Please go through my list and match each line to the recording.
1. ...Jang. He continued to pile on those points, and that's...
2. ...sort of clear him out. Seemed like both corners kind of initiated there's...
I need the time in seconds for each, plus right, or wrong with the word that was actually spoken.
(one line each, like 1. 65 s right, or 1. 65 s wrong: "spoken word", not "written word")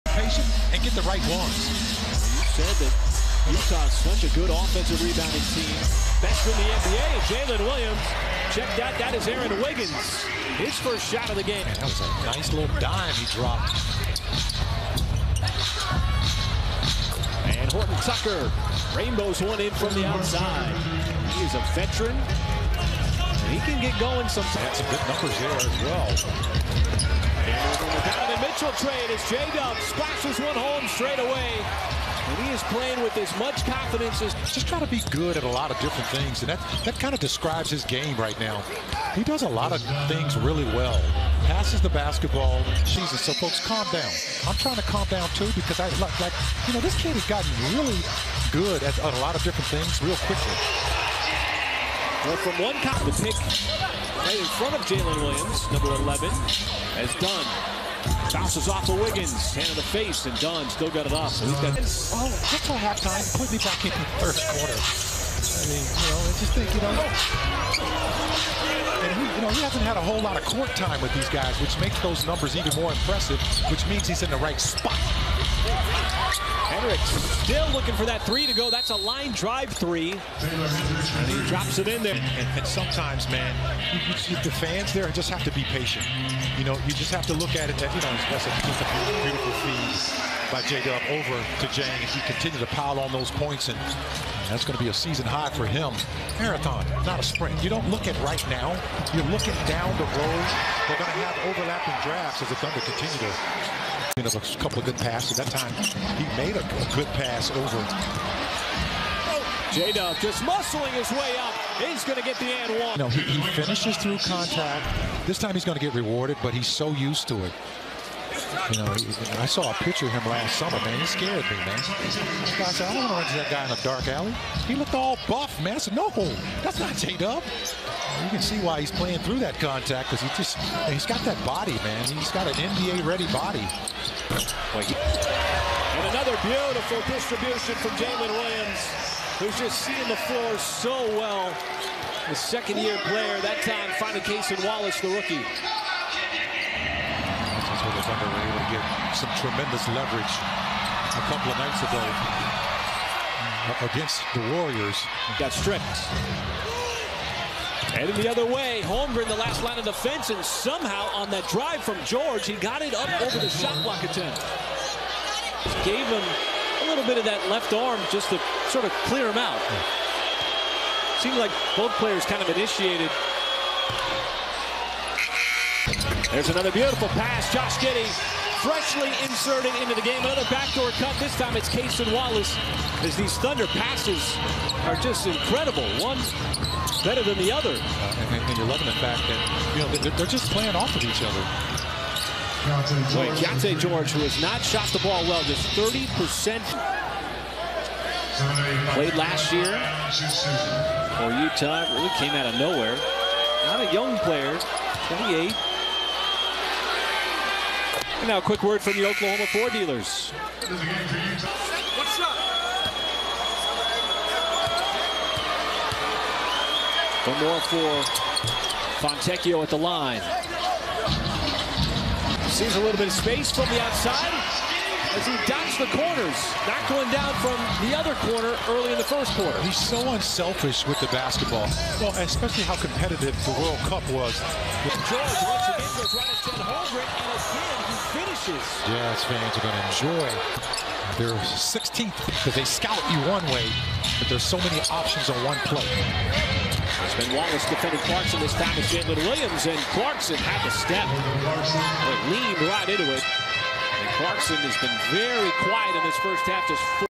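1. 91 s right
2. 168 s wrong: "players", not "corners".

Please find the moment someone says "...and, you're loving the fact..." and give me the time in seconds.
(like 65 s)
188 s.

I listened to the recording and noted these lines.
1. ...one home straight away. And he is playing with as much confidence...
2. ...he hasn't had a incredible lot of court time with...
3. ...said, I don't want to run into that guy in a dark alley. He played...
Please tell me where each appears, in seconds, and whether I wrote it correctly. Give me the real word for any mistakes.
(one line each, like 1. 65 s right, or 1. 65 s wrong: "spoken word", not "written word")
1. 30 s right
2. 69 s wrong: "whole", not "incredible"
3. 122 s wrong: "looked", not "played".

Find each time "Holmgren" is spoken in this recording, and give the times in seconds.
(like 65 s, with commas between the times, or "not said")
158 s, 236 s.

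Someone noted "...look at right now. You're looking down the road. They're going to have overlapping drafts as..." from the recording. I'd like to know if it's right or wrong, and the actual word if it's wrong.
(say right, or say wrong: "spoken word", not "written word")
right.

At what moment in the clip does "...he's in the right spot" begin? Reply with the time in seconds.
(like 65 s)
74 s.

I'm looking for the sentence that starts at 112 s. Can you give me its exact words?
No, he, he finishes through contact.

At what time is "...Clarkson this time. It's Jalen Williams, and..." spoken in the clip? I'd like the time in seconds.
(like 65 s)
248 s.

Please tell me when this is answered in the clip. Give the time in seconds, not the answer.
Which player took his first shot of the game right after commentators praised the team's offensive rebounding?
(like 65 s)
9 s.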